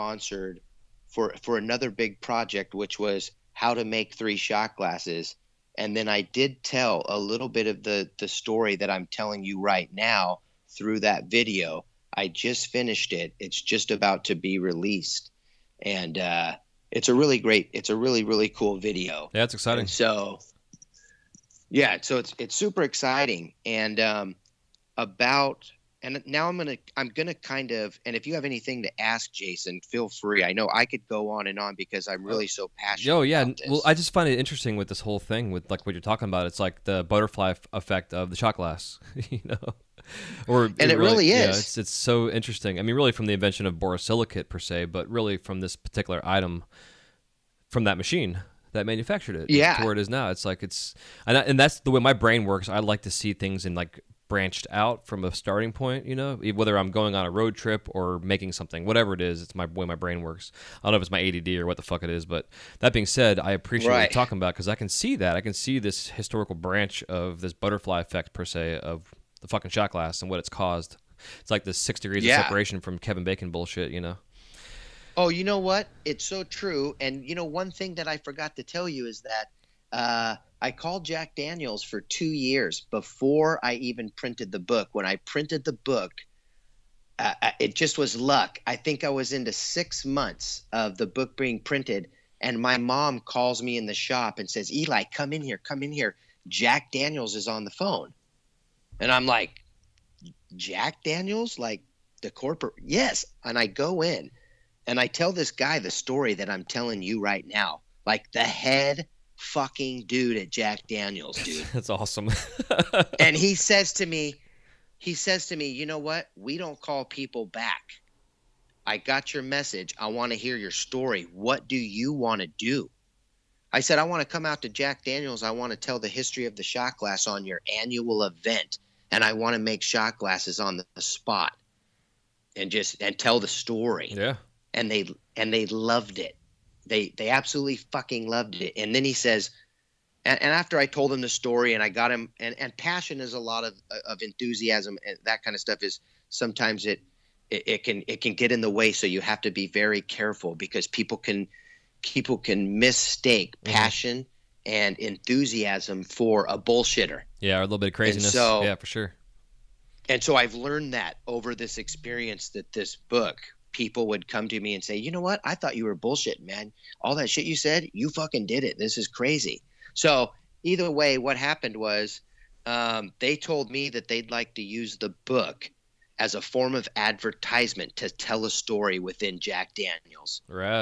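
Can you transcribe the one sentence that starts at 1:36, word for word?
Jack Daniels is on the phone." And I'm like, Jack Daniels, like the corporate.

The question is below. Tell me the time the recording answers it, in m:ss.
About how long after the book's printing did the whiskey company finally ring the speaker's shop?
1:29.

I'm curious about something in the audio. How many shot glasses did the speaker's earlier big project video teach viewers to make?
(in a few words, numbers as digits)
3.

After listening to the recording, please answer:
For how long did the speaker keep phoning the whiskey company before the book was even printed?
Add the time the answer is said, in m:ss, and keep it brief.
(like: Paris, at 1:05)
2 years, at 1:21.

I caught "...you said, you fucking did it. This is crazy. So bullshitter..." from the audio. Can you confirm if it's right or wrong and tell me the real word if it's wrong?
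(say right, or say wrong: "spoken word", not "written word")
wrong: "either", not "bullshitter".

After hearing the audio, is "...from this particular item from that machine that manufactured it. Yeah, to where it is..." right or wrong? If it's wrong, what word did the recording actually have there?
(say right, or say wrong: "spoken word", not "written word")
right.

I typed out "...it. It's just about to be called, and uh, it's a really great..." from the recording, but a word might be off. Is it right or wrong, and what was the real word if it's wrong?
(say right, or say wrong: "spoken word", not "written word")
wrong: "released", not "called".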